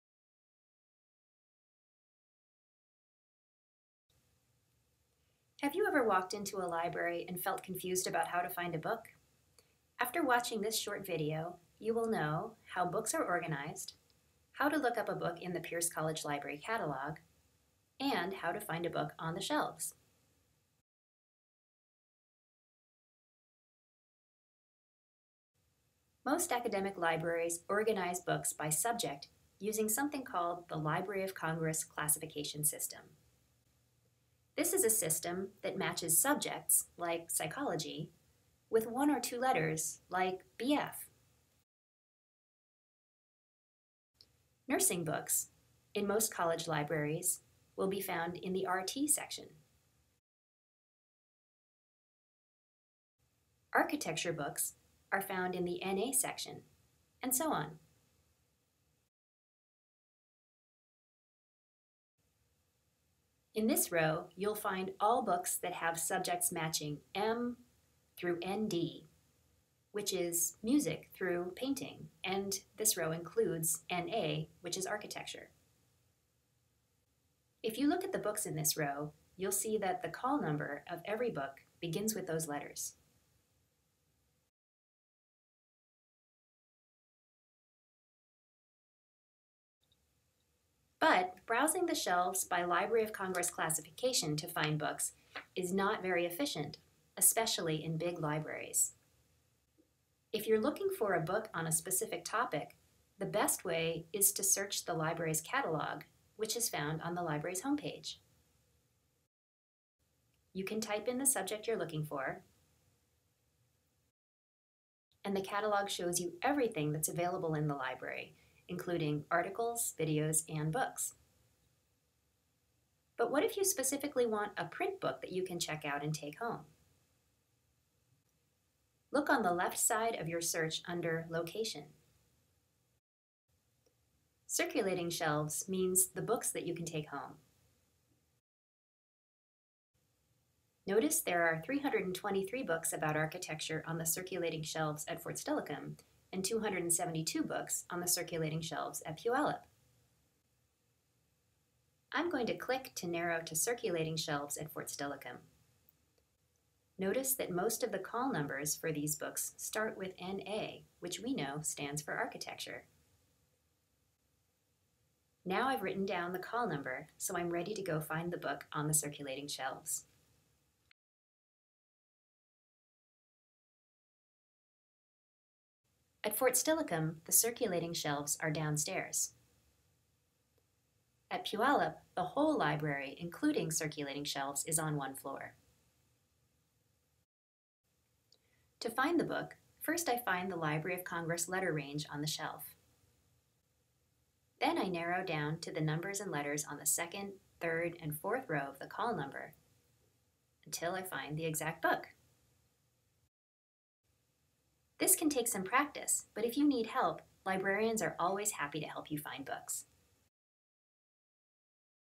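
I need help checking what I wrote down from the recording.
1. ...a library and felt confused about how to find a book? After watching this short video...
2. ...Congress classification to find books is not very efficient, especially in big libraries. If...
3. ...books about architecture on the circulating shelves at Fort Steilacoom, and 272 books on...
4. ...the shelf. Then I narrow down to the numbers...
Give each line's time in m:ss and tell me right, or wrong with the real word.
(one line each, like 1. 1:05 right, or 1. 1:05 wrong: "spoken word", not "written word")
1. 0:06 right
2. 1:33 right
3. 2:22 right
4. 3:12 right.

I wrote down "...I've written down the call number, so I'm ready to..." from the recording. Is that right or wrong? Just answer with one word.
right.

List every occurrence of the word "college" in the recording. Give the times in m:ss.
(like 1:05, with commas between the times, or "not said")
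0:15, 0:46.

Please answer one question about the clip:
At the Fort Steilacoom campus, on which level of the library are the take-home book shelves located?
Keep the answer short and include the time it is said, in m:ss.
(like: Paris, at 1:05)
Downstairs, at 2:58.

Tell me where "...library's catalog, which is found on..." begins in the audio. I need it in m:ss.
1:44.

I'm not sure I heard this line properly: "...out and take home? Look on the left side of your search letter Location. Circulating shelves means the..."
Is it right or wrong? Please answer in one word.
wrong.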